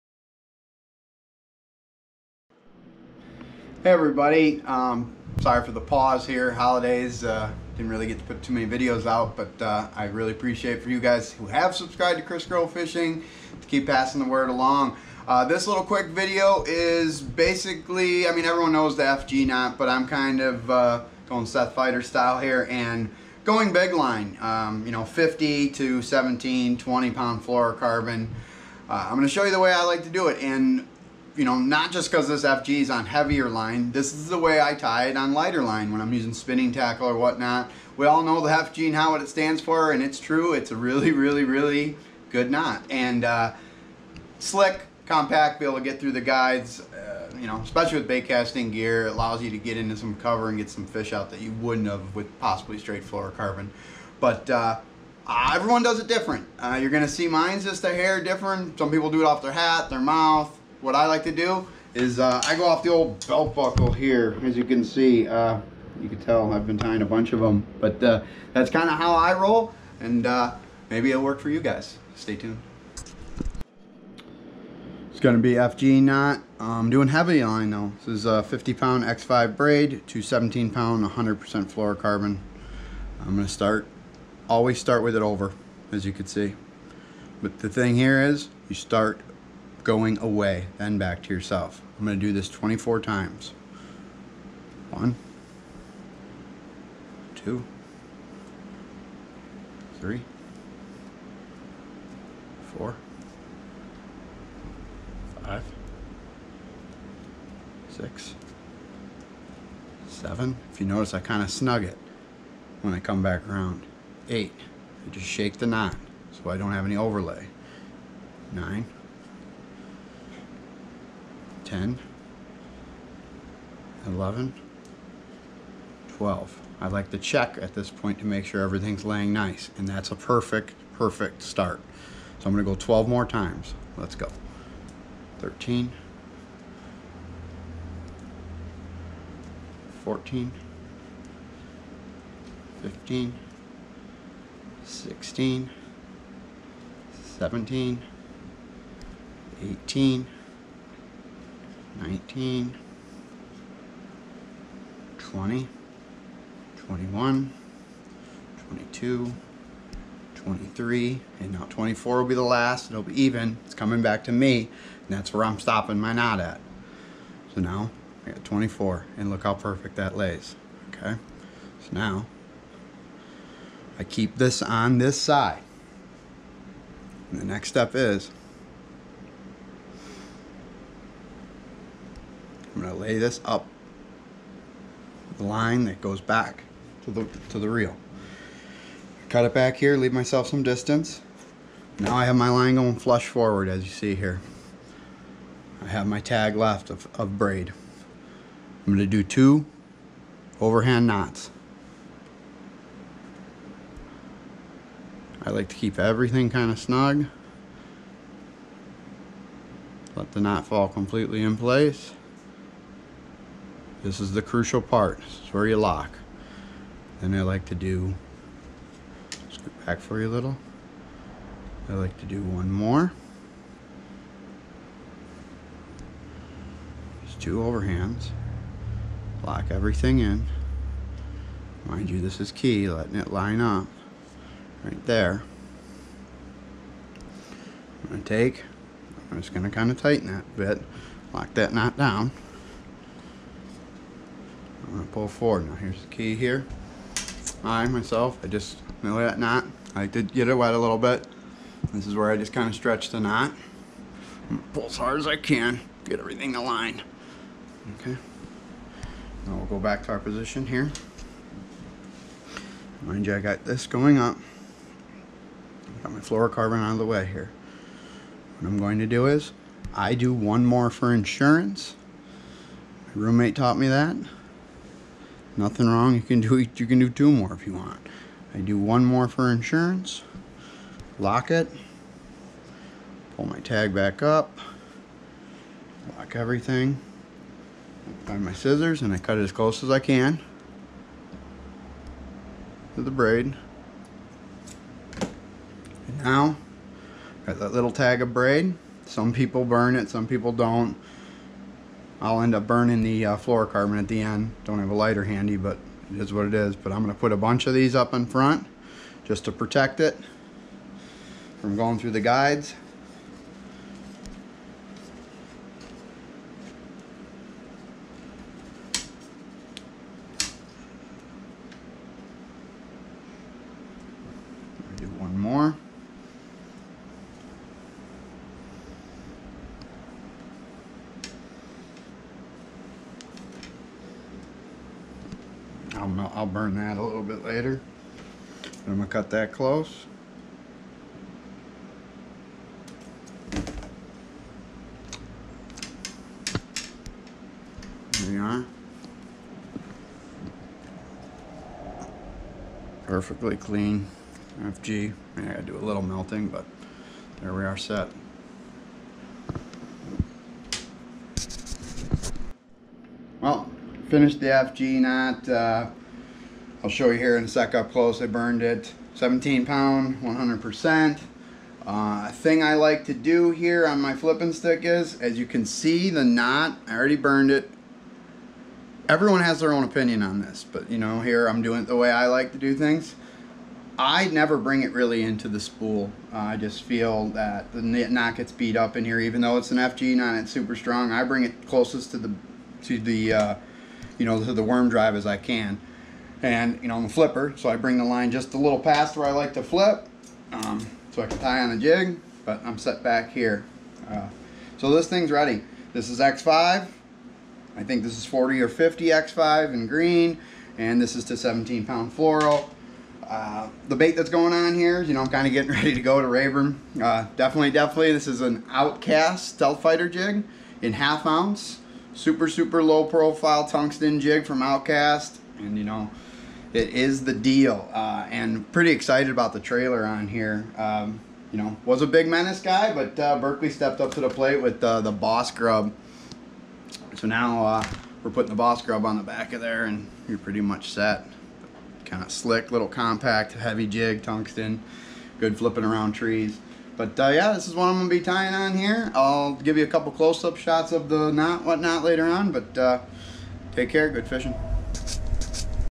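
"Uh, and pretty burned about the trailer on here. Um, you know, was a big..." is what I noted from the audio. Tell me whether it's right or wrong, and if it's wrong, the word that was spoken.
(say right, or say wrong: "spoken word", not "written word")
wrong: "excited", not "burned".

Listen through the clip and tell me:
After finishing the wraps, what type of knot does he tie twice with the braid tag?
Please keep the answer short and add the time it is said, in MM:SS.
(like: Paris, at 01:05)
Overhand knots, at 03:20.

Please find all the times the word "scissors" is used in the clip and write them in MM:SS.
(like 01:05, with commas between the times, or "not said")
04:48.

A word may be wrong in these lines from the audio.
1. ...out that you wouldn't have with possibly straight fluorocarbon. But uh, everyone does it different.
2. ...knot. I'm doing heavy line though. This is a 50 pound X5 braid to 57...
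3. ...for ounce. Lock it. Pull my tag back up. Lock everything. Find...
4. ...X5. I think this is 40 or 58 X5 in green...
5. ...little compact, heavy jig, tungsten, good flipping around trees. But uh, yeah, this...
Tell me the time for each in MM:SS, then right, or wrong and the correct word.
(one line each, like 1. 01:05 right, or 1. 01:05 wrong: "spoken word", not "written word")
1. 00:51 right
2. 01:16 wrong: "17", not "57"
3. 04:39 wrong: "insurance", not "ounce"
4. 06:46 wrong: "50", not "58"
5. 07:22 right.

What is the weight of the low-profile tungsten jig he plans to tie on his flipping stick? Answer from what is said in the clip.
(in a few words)
Half ounce.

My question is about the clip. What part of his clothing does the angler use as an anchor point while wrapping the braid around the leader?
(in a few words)
Belt buckle.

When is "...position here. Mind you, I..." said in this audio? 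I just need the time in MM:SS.
04:20.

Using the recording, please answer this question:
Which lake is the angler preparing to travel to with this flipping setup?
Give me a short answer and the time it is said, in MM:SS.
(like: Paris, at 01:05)
Rayburn, at 06:56.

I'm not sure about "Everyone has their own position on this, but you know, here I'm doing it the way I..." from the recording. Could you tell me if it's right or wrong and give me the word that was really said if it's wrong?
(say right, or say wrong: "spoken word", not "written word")
wrong: "opinion", not "position".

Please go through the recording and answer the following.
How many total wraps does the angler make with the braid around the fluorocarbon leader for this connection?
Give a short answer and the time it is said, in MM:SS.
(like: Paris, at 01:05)
24, at 01:32.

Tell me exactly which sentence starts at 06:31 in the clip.
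I bring it closest to the to the uh, you know, to the worm drive as I can.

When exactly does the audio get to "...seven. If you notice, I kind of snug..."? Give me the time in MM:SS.
01:50.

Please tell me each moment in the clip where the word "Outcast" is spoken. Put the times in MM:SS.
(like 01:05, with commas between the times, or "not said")
06:58, 07:04.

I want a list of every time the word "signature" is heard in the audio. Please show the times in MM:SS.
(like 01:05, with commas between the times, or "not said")
not said.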